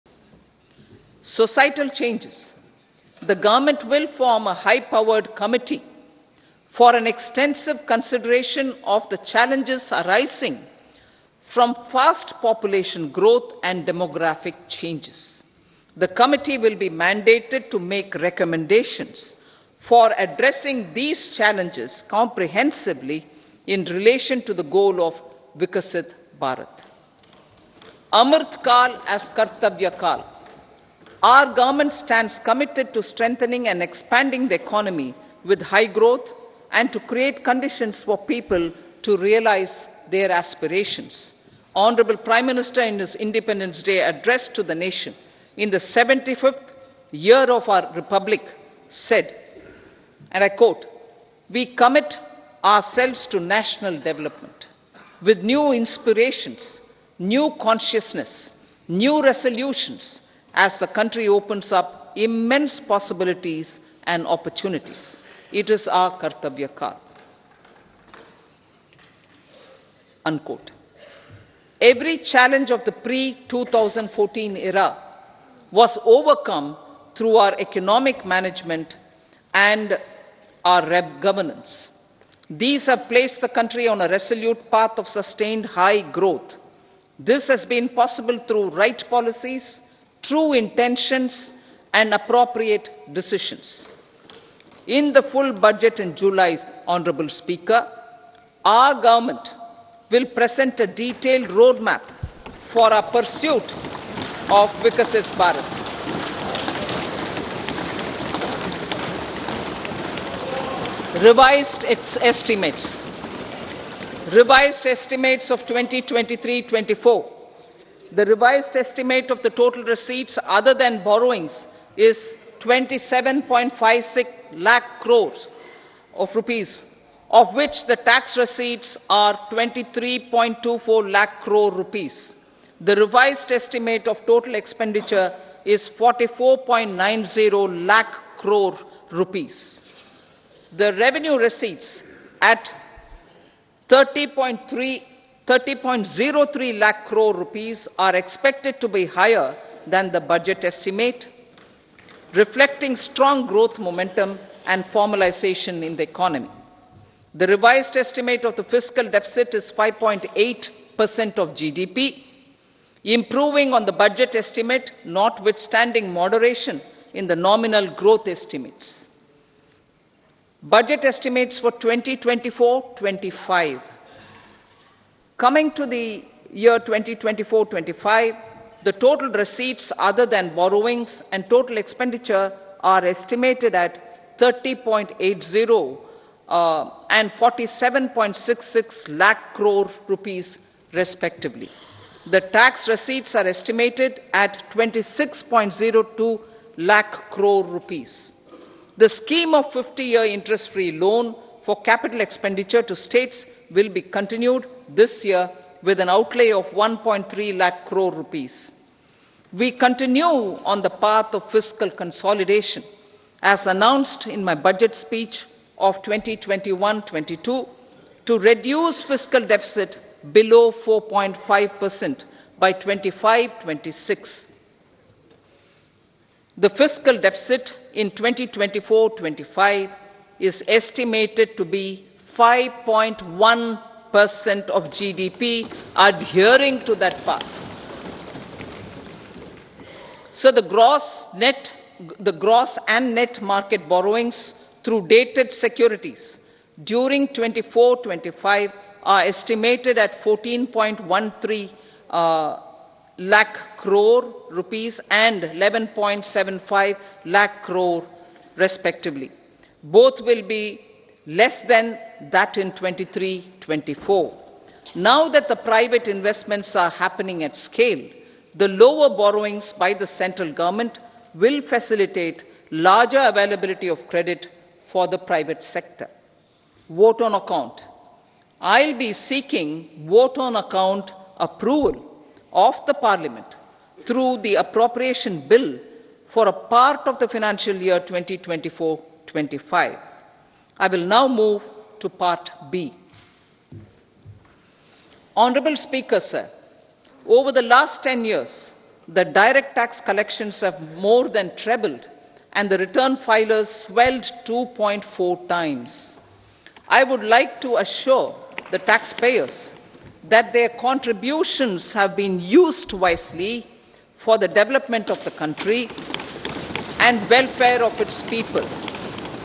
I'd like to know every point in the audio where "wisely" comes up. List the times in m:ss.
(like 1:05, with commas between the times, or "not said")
5:12.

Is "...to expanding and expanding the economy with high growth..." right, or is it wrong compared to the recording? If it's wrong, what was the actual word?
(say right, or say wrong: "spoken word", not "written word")
wrong: "strengthening", not "expanding".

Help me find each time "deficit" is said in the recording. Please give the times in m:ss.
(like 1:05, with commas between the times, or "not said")
2:39, 3:39, 3:47.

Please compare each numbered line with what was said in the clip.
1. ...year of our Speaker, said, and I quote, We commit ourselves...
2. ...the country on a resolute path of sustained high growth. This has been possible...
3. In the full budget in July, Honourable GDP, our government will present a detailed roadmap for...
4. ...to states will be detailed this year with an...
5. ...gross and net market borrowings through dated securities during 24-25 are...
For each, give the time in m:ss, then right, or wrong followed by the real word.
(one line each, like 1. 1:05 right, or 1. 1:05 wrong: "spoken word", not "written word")
1. 0:47 wrong: "Republic", not "Speaker"
2. 1:23 right
3. 1:34 wrong: "Speaker", not "GDP"
4. 3:22 wrong: "continued", not "detailed"
5. 4:02 right.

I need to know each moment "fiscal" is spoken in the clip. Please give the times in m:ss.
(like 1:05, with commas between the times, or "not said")
2:38, 3:31, 3:39, 3:46.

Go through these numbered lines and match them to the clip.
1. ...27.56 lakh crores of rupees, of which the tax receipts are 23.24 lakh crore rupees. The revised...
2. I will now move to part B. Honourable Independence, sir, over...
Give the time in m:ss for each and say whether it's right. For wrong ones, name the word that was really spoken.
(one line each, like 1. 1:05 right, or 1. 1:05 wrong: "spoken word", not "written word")
1. 2:02 right
2. 4:50 wrong: "Speaker", not "Independence".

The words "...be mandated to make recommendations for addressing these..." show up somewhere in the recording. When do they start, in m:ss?
0:16.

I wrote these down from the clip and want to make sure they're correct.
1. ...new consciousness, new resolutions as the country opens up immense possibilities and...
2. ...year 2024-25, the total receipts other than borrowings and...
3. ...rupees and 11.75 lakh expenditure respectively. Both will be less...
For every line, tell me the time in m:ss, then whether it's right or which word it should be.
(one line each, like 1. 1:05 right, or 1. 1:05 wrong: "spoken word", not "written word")
1. 0:57 right
2. 2:56 right
3. 4:14 wrong: "crore", not "expenditure".